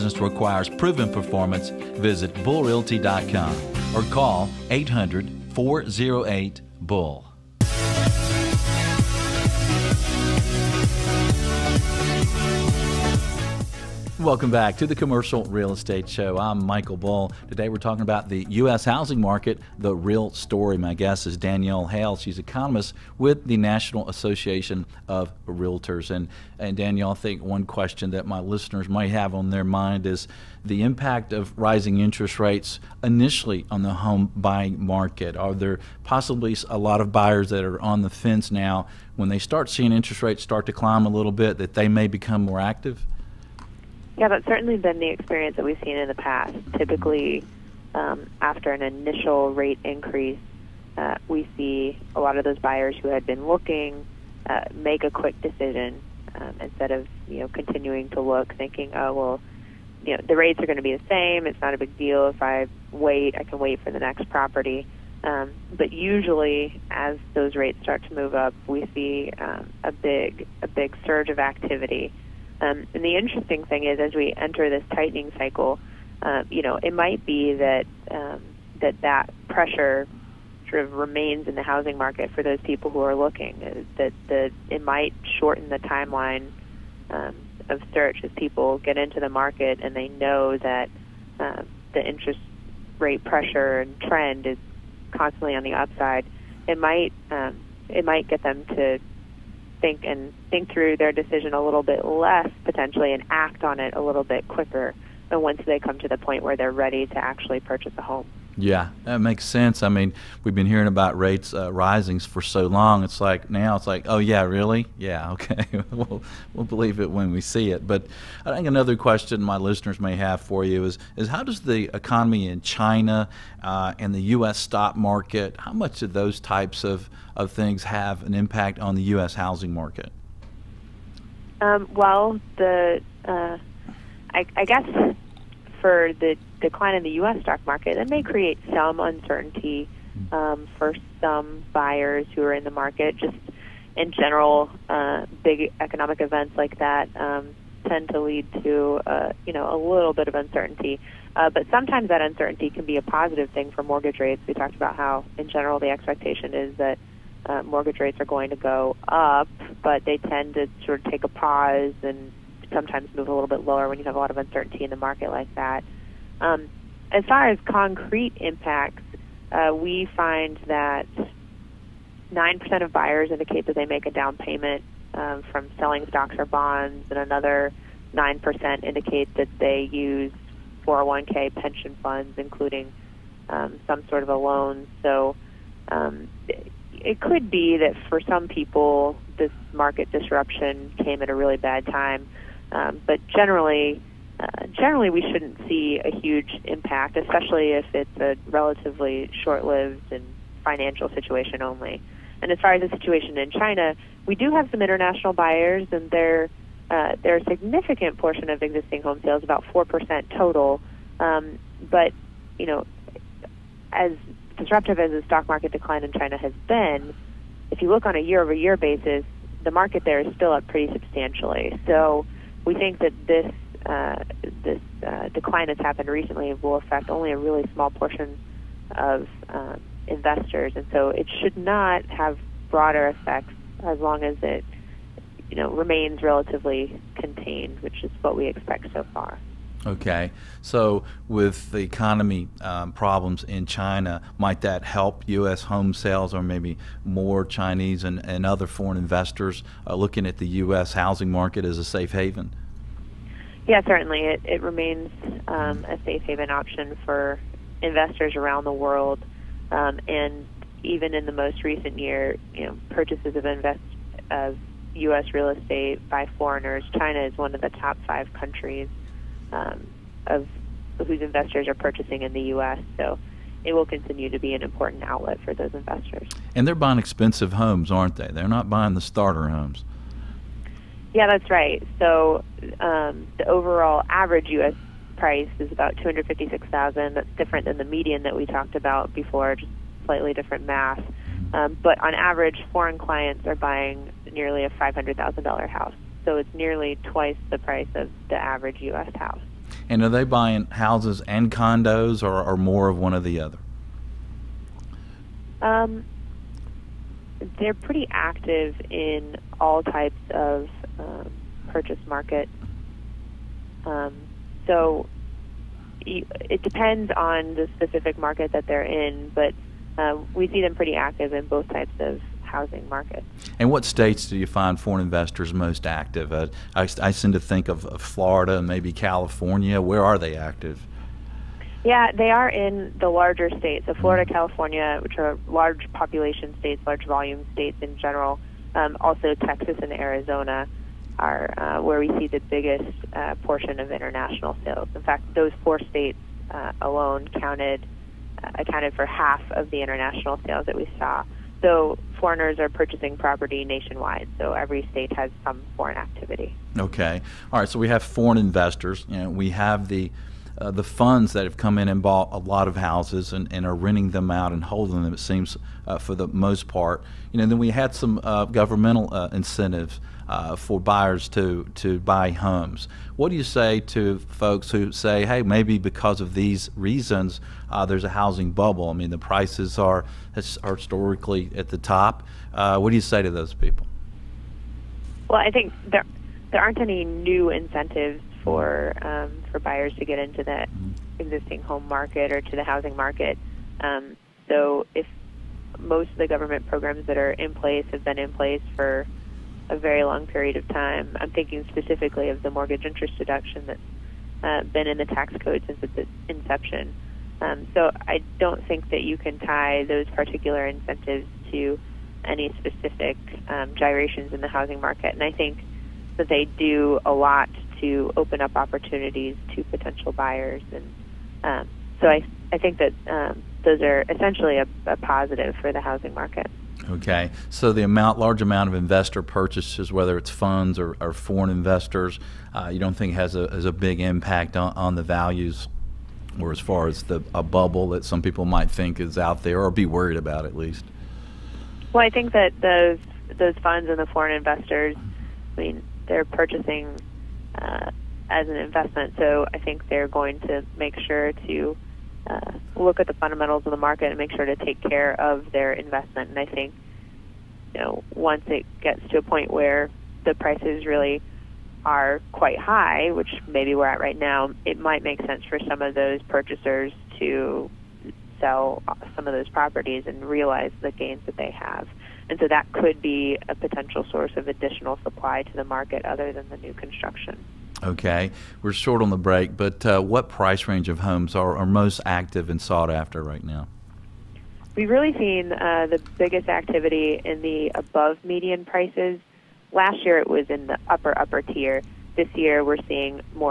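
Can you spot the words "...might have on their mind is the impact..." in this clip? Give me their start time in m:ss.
0:28.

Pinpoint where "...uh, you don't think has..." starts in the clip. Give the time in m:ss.
7:12.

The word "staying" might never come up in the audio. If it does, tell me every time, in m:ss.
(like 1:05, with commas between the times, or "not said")
not said.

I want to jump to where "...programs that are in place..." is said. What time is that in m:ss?
6:36.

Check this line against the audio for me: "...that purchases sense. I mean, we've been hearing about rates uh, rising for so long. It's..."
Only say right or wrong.
wrong.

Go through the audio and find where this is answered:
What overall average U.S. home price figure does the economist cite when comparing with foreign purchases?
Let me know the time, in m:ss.
4:45.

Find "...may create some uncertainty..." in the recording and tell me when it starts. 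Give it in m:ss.
2:18.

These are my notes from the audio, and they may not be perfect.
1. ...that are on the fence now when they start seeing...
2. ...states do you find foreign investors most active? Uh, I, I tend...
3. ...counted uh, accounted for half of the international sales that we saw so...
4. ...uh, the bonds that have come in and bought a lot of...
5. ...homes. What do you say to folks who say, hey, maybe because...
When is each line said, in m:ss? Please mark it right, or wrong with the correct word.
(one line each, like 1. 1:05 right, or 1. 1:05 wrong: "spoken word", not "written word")
1. 0:37 right
2. 5:23 right
3. 5:47 right
4. 6:00 wrong: "funds", not "bonds"
5. 6:12 right.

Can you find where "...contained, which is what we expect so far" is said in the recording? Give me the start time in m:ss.
3:57.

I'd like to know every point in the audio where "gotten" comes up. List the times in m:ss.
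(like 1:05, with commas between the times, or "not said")
not said.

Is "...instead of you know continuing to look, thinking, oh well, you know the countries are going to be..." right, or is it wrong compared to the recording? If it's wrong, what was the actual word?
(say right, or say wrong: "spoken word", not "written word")
wrong: "rates", not "countries".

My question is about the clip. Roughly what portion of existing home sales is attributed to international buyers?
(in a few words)
4%.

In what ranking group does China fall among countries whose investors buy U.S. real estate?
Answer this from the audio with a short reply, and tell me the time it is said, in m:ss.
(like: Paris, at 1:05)
Top 5, at 4:27.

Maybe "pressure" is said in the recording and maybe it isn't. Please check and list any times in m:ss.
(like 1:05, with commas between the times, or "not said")
1:19, 1:33.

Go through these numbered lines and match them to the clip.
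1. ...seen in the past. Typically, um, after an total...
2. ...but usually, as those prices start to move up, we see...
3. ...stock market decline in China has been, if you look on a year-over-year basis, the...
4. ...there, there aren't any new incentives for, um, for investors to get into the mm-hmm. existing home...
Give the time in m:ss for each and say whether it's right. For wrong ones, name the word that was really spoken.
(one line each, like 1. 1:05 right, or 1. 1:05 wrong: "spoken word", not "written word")
1. 0:45 wrong: "initial", not "total"
2. 1:05 wrong: "rates", not "prices"
3. 3:35 right
4. 6:25 wrong: "buyers", not "investors".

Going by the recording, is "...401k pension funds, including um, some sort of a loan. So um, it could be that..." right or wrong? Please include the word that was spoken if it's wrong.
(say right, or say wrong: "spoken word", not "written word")
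right.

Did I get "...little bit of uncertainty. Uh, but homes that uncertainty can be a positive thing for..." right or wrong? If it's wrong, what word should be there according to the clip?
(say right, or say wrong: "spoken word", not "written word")
wrong: "sometimes", not "homes".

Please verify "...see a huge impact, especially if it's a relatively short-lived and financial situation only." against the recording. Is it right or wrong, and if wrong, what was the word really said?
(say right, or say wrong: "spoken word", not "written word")
right.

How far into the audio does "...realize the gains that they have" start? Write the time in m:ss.
7:50.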